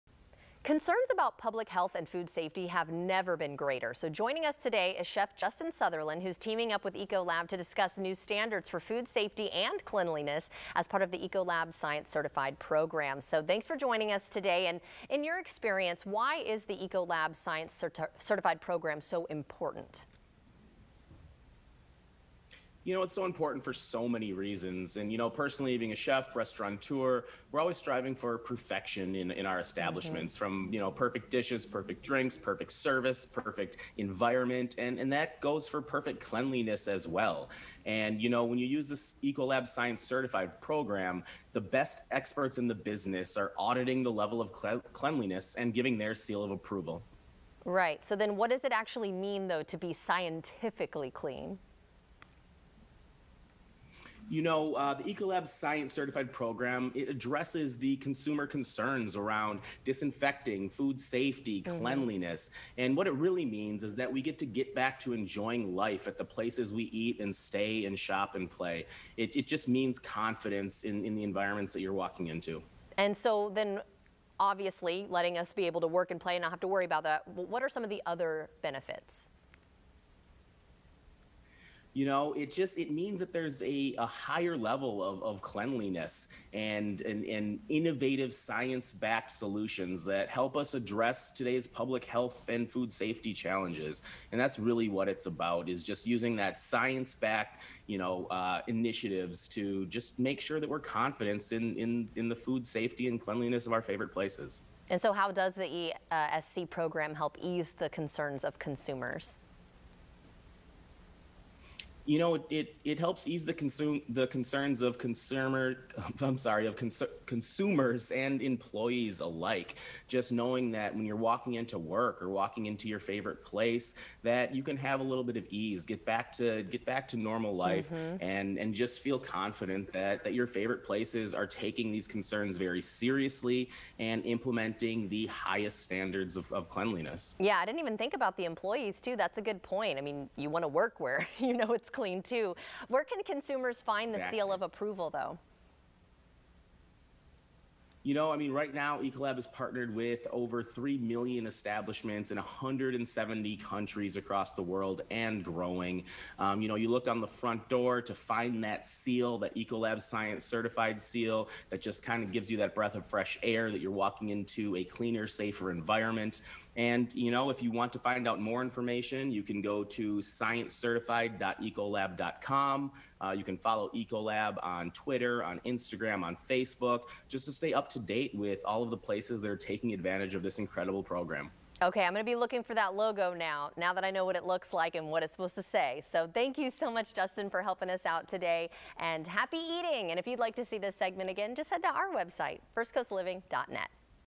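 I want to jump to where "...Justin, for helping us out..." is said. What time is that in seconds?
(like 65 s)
187 s.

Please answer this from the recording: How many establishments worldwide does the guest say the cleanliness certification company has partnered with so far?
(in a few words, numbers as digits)
3 million.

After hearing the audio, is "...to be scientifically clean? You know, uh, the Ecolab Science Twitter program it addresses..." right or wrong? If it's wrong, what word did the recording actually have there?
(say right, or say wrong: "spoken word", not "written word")
wrong: "Certified", not "Twitter".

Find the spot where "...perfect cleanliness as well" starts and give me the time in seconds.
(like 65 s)
35 s.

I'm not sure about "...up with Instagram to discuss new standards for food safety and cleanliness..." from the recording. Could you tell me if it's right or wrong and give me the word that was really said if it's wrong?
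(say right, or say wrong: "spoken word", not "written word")
wrong: "Ecolab", not "Instagram".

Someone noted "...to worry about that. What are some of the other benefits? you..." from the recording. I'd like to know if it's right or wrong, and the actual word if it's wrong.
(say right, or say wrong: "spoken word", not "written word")
right.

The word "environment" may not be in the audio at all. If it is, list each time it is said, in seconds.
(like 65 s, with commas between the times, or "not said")
33 s, 71 s, 165 s.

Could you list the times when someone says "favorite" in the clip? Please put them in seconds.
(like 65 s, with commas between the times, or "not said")
103 s, 122 s, 130 s.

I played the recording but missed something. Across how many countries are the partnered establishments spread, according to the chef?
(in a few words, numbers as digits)
170.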